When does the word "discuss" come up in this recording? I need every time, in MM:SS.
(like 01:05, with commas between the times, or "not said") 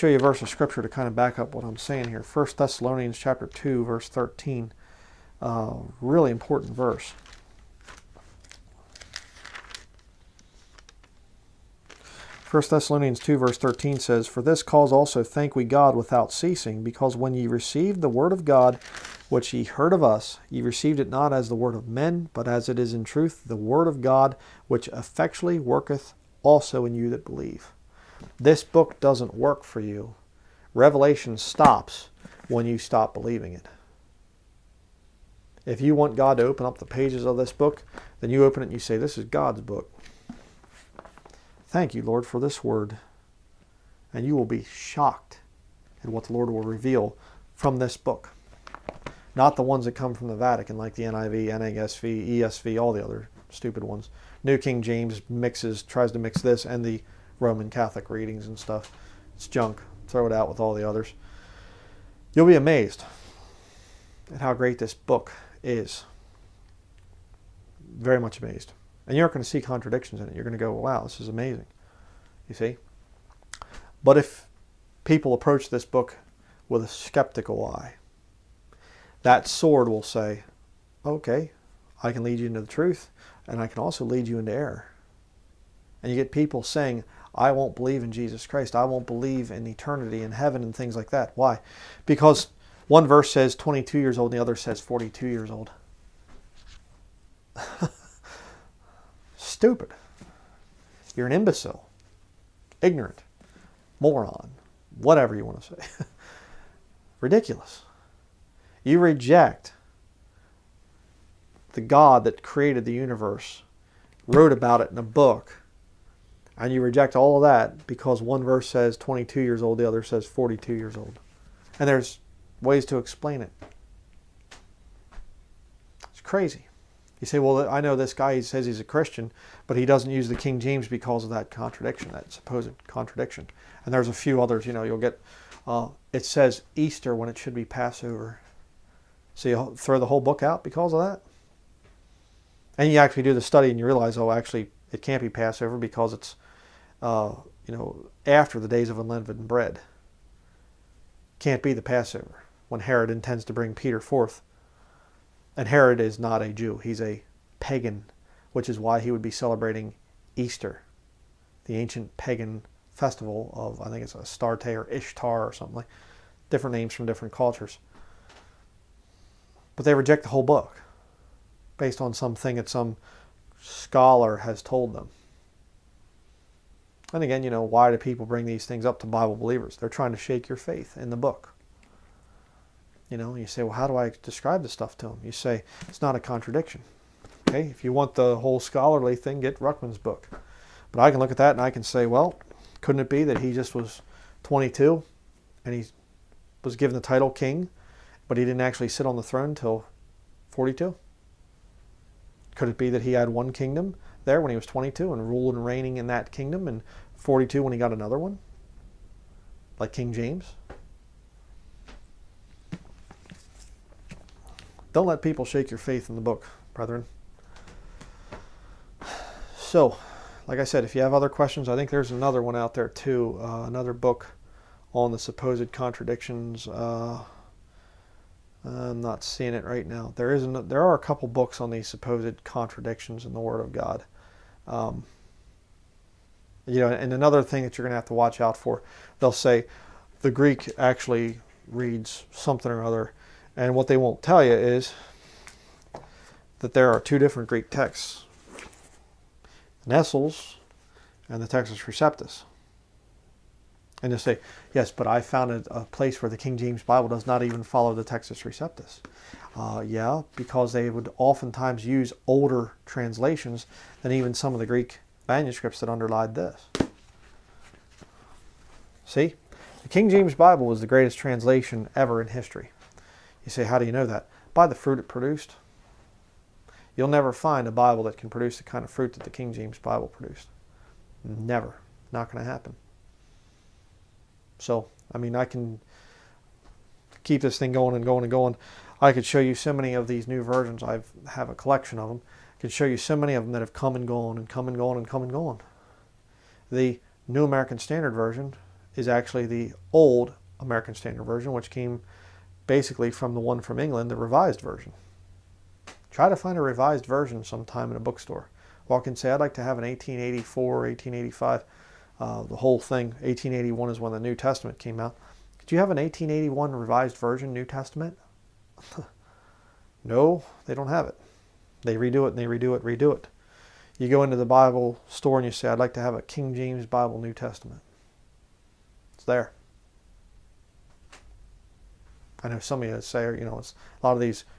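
not said.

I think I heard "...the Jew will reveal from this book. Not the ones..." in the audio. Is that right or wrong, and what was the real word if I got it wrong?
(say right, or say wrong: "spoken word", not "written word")
wrong: "Lord", not "Jew".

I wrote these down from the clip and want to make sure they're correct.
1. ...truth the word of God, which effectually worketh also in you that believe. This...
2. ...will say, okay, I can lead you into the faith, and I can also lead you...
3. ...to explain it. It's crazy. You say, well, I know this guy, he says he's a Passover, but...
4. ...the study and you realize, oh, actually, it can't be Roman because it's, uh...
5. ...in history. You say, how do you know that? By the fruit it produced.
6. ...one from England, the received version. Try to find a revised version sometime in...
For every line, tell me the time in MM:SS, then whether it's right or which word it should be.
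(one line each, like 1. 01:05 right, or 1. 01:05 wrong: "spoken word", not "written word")
1. 00:23 right
2. 01:19 wrong: "truth", not "faith"
3. 02:02 wrong: "Christian", not "Passover"
4. 02:23 wrong: "Passover", not "Roman"
5. 04:32 right
6. 05:03 wrong: "revised", not "received".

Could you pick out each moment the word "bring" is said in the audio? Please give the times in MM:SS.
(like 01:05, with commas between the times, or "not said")
02:33, 02:58.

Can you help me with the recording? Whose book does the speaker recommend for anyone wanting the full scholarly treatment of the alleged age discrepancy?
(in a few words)
Ruckman.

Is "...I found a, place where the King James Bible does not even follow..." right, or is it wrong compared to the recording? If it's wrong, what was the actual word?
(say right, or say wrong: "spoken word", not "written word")
right.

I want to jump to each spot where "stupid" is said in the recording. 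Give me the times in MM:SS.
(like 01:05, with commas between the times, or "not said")
00:53, 01:39.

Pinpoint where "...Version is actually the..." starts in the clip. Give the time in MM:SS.
04:58.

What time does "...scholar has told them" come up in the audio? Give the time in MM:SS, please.
02:53.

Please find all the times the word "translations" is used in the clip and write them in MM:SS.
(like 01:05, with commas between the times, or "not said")
04:22, 04:31.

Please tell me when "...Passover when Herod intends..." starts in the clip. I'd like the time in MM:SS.
02:31.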